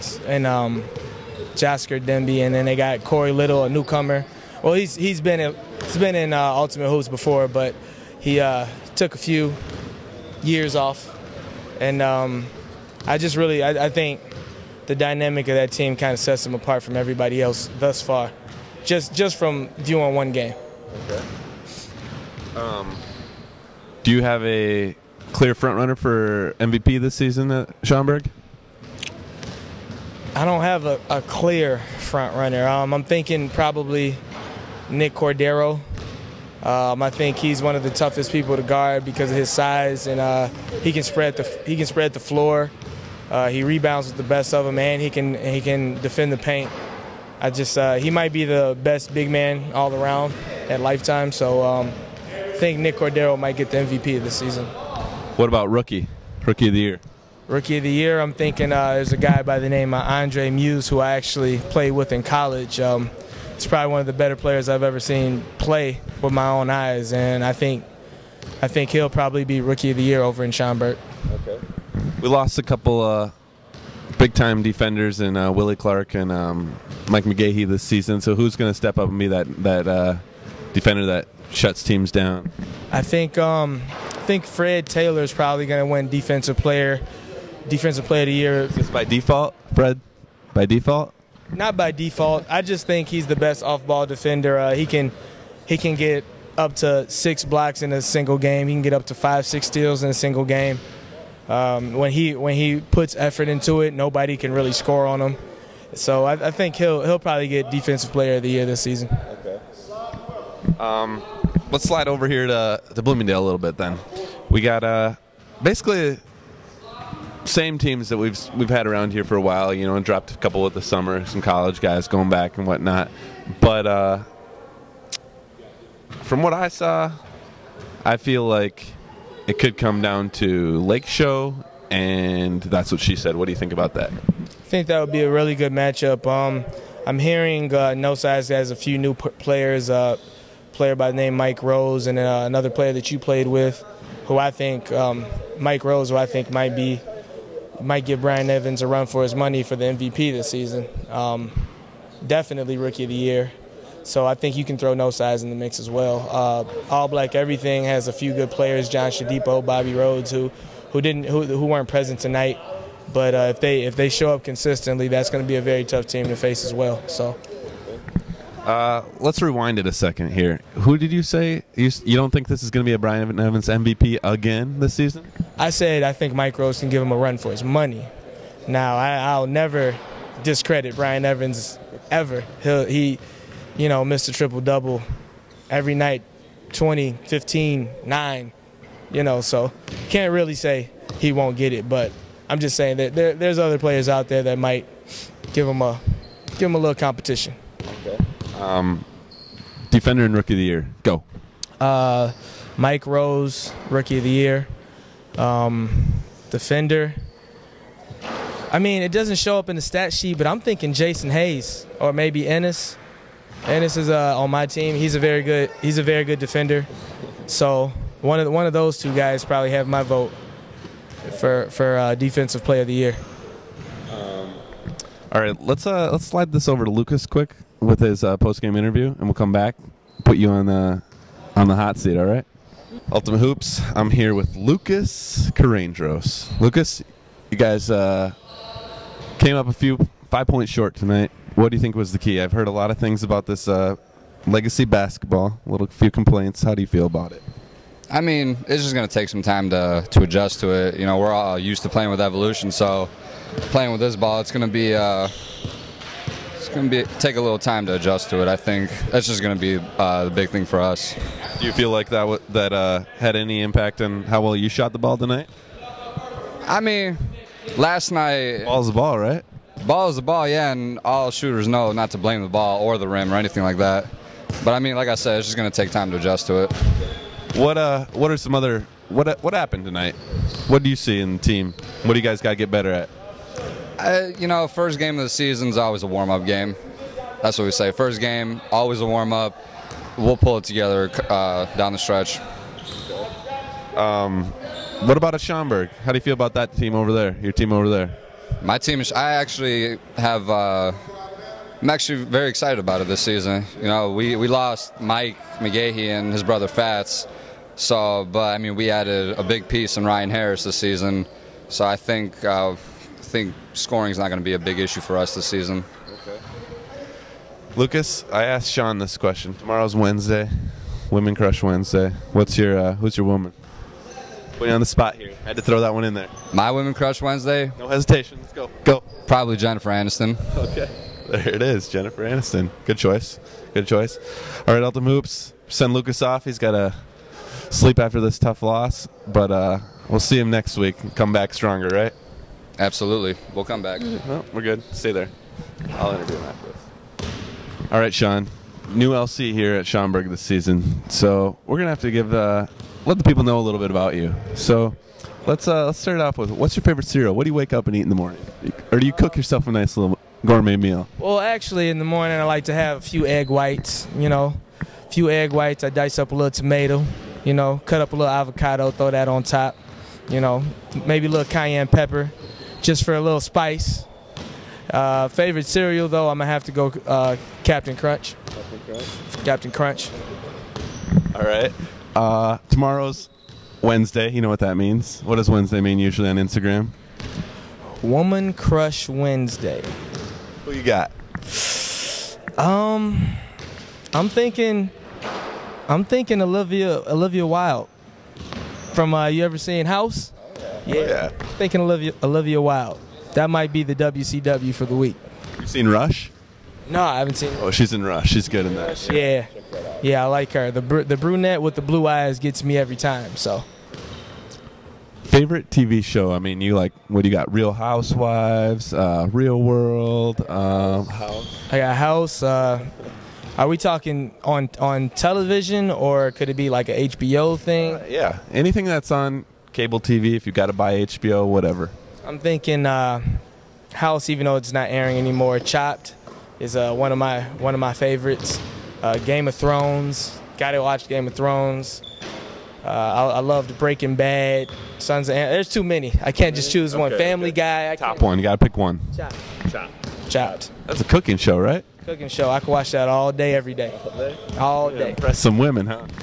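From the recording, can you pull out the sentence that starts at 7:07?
Uh, yeah, anything that's on cable TV, if you got to buy HBO, whatever?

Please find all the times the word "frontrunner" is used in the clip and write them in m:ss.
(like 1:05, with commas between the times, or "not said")
0:25, 0:31.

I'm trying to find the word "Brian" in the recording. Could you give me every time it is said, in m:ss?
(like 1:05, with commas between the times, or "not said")
2:28, 2:52, 3:00.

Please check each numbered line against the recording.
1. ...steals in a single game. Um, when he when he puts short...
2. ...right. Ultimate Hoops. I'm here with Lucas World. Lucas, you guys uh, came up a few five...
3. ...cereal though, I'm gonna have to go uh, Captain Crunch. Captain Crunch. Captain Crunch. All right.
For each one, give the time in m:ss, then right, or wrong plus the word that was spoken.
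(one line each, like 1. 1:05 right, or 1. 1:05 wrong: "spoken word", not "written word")
1. 1:39 wrong: "effort", not "short"
2. 3:52 wrong: "Carandros", not "World"
3. 6:15 right.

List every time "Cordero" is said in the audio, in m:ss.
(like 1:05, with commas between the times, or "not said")
0:35, 0:52.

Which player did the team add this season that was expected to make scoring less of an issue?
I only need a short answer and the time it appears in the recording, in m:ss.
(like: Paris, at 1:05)
Ryan Harris, at 5:10.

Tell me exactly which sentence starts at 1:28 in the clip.
Just by default, Fred, by default.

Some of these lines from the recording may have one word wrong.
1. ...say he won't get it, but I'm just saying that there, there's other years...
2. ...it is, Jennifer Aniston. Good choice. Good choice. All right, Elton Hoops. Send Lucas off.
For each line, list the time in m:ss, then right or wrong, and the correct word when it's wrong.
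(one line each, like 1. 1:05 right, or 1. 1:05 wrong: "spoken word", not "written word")
1. 3:10 wrong: "players", not "years"
2. 5:31 right.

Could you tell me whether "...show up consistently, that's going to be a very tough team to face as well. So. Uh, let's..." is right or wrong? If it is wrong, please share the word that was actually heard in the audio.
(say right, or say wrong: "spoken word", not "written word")
right.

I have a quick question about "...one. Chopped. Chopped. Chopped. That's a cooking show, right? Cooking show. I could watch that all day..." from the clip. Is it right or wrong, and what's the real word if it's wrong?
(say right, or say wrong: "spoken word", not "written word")
right.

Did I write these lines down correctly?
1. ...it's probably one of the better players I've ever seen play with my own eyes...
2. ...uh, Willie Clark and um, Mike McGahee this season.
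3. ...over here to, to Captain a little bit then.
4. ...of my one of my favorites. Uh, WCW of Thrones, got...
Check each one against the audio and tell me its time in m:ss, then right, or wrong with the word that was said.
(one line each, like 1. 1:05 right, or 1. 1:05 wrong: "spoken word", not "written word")
1. 1:03 right
2. 1:15 right
3. 1:52 wrong: "Bloomingdale", not "Captain"
4. 7:17 wrong: "Game", not "WCW".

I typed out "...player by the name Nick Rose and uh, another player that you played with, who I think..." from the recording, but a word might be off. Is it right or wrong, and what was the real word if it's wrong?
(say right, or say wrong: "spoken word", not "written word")
wrong: "Mike", not "Nick".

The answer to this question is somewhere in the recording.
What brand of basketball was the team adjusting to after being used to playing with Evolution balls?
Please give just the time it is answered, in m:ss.
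4:04.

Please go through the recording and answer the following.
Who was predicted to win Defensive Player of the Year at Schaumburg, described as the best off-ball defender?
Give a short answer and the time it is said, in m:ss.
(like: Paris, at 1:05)
Fred Taylor, at 1:24.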